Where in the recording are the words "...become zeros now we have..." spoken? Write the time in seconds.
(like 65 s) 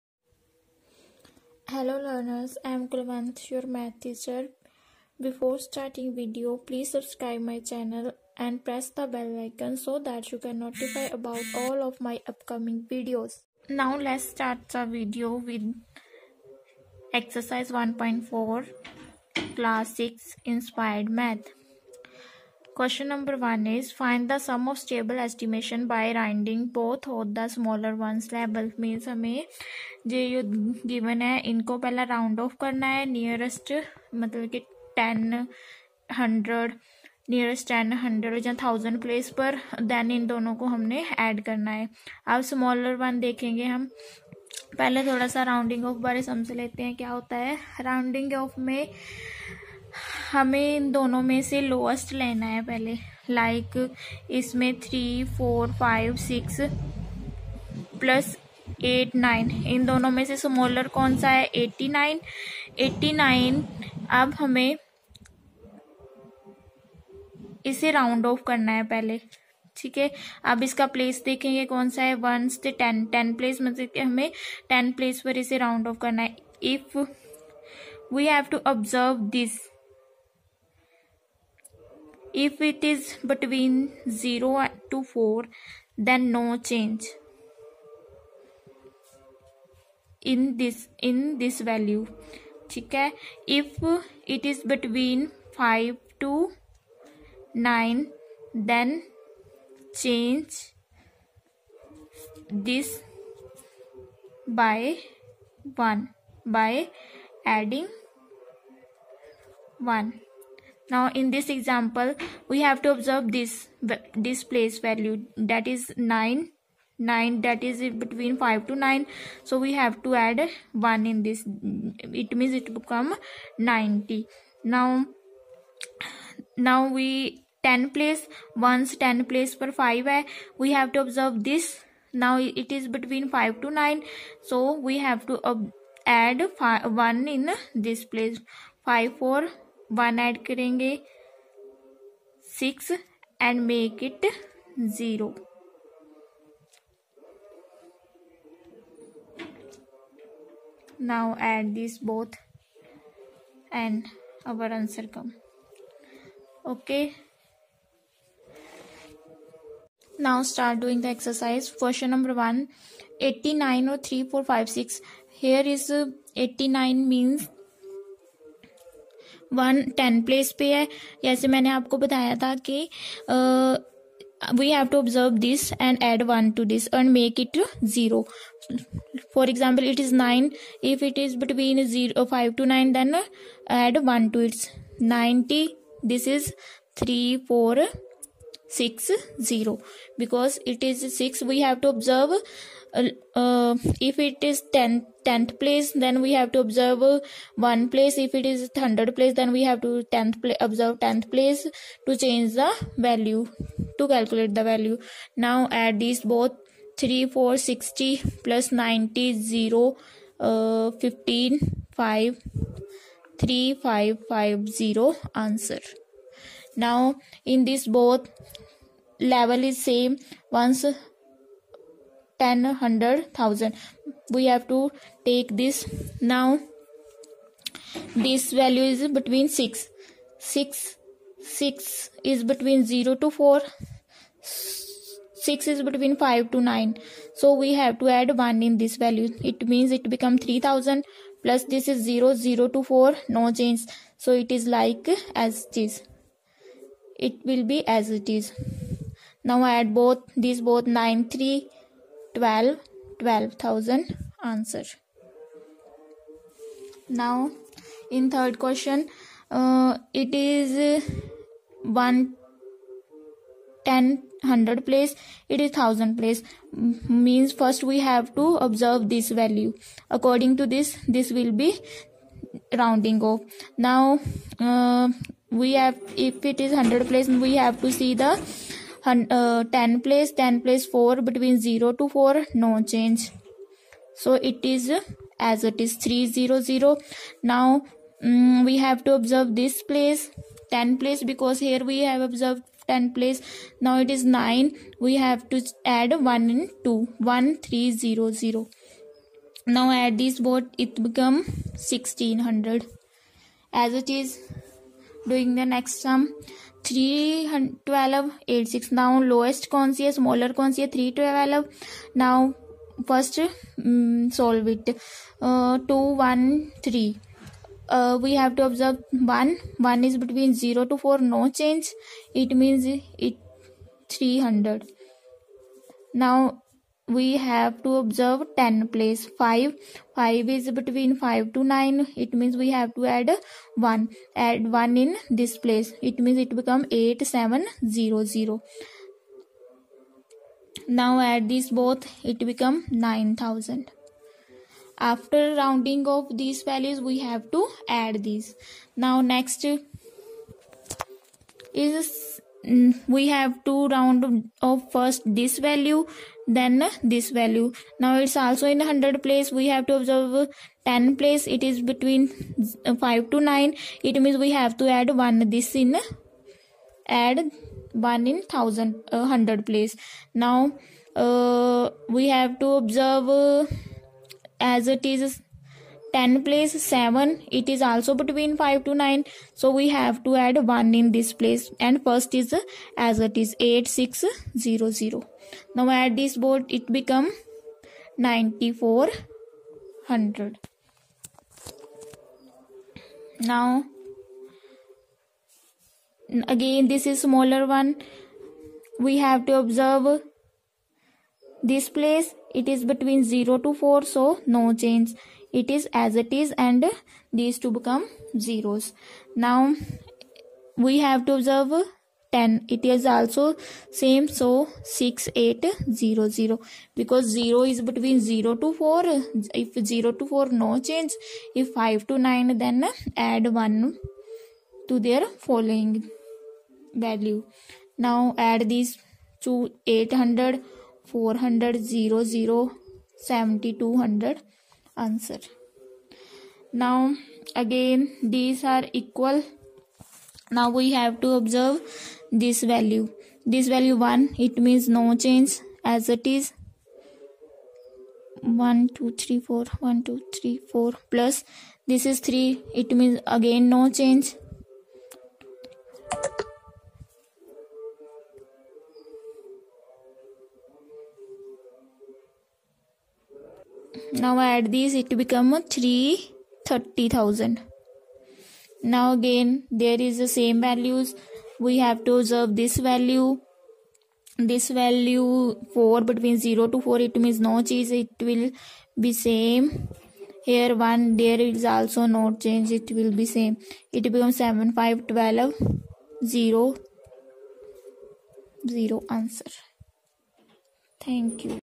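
407 s.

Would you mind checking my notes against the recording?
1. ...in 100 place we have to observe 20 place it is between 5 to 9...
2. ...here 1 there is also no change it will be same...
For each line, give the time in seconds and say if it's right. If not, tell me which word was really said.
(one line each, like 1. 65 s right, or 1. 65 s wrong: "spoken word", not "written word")
1. 358 s wrong: "10", not "20"
2. 480 s right.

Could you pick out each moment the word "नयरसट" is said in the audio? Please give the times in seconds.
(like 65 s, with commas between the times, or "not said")
33 s, 37 s.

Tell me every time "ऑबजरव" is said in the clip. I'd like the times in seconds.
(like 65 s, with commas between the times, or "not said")
78 s, 174 s, 191 s, 318 s.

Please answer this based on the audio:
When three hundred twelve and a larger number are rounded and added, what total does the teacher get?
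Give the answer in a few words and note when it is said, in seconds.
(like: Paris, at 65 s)
9000, at 343 s.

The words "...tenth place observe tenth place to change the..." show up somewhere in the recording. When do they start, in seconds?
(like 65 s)
200 s.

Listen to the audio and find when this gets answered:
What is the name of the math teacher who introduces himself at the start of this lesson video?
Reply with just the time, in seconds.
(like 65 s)
2 s.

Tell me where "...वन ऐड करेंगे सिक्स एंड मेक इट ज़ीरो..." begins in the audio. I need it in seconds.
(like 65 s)
139 s.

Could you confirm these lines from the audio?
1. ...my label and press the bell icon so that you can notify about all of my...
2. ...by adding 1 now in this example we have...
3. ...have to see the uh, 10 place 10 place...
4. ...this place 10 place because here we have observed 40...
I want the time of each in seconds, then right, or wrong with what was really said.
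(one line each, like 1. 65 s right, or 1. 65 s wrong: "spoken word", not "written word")
1. 7 s wrong: "channel", not "label"
2. 106 s right
3. 277 s right
4. 289 s wrong: "10", not "40".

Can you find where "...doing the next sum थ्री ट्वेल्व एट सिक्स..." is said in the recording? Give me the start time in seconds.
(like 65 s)
305 s.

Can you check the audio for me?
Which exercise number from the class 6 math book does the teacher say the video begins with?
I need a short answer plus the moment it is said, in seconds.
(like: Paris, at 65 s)
1.4, at 17 s.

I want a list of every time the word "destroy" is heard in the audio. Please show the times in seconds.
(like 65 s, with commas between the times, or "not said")
not said.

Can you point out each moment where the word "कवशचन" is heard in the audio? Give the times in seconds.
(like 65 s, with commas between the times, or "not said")
22 s, 161 s.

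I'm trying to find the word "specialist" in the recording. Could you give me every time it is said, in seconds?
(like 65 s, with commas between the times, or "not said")
not said.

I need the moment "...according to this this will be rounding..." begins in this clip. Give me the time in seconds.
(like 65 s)
270 s.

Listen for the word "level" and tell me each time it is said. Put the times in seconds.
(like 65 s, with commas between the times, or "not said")
219 s.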